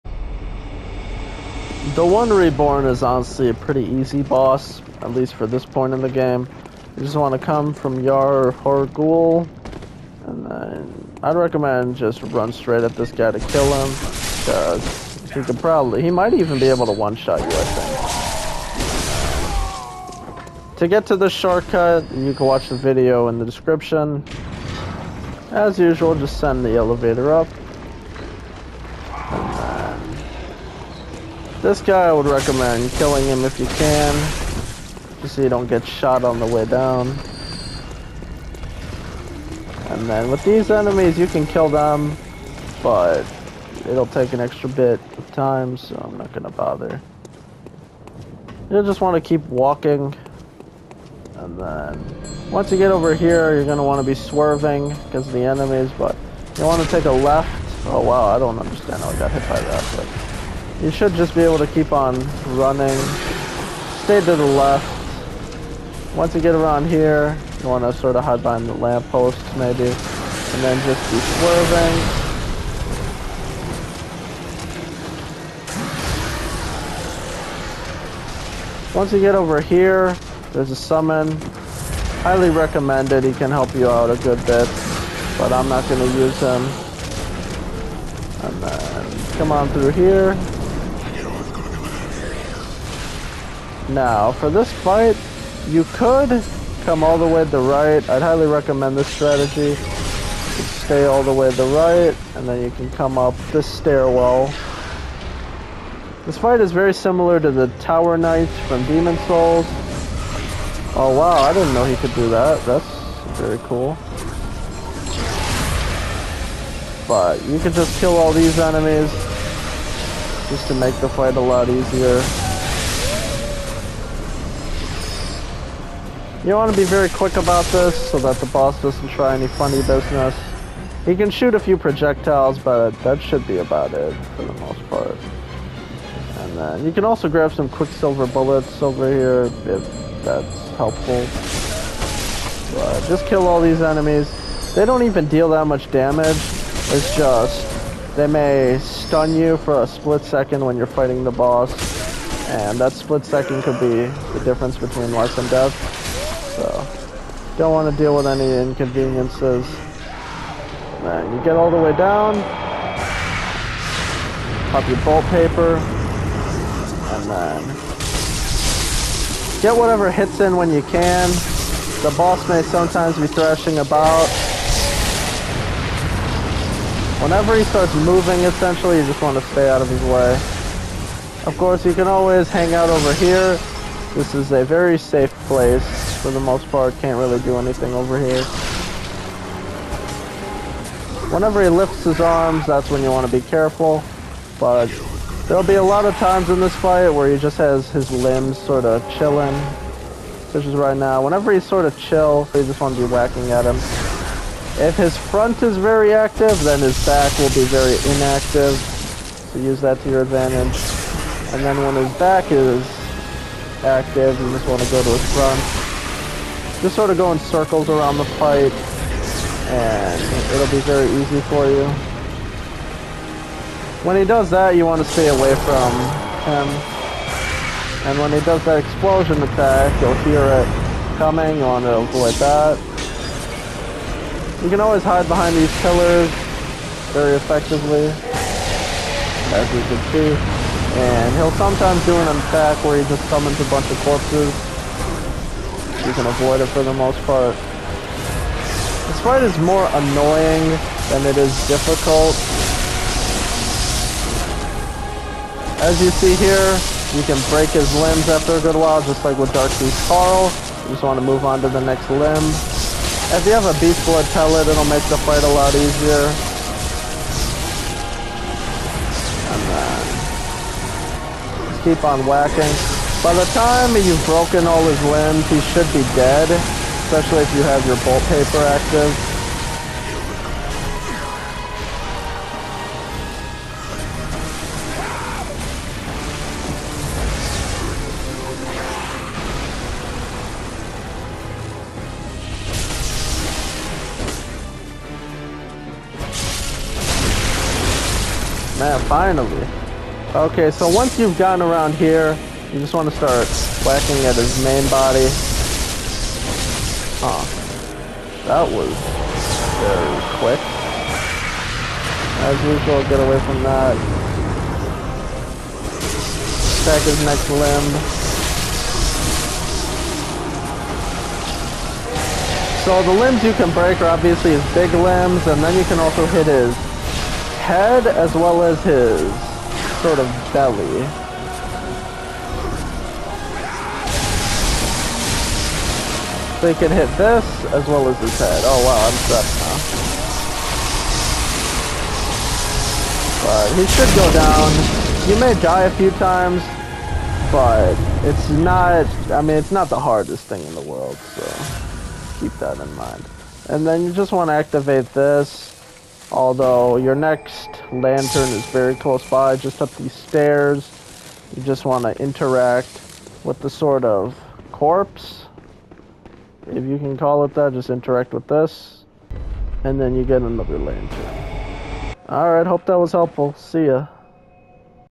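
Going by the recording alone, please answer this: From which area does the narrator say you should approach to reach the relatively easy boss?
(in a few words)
Yahar'gul.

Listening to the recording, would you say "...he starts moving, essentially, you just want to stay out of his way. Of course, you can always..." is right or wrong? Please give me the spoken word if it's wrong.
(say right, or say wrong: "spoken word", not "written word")
right.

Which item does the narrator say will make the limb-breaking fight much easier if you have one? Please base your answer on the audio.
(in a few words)
Beast Blood pellet.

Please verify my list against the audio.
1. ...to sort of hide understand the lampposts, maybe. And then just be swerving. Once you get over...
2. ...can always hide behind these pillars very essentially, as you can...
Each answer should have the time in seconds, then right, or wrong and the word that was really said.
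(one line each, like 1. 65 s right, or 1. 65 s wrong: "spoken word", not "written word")
1. 67 s wrong: "behind", not "understand"
2. 234 s wrong: "effectively", not "essentially".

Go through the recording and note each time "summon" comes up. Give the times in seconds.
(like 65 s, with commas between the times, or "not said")
80 s, 243 s.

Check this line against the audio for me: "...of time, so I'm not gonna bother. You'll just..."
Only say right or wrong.
right.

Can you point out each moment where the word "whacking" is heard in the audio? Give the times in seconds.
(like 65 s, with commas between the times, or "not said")
203 s, 272 s, 303 s.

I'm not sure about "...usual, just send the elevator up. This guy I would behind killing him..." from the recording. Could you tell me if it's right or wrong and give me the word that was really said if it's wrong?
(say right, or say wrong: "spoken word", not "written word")
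wrong: "recommend", not "behind".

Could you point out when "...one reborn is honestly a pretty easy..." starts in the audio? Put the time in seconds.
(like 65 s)
2 s.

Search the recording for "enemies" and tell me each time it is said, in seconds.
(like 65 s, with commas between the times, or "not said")
40 s, 55 s, 118 s, 143 s.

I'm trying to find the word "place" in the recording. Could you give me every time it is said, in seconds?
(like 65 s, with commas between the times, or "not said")
185 s.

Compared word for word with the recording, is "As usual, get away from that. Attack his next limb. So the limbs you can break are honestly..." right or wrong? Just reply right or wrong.
wrong.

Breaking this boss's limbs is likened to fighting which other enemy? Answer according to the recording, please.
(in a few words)
Darkbeast Paarl.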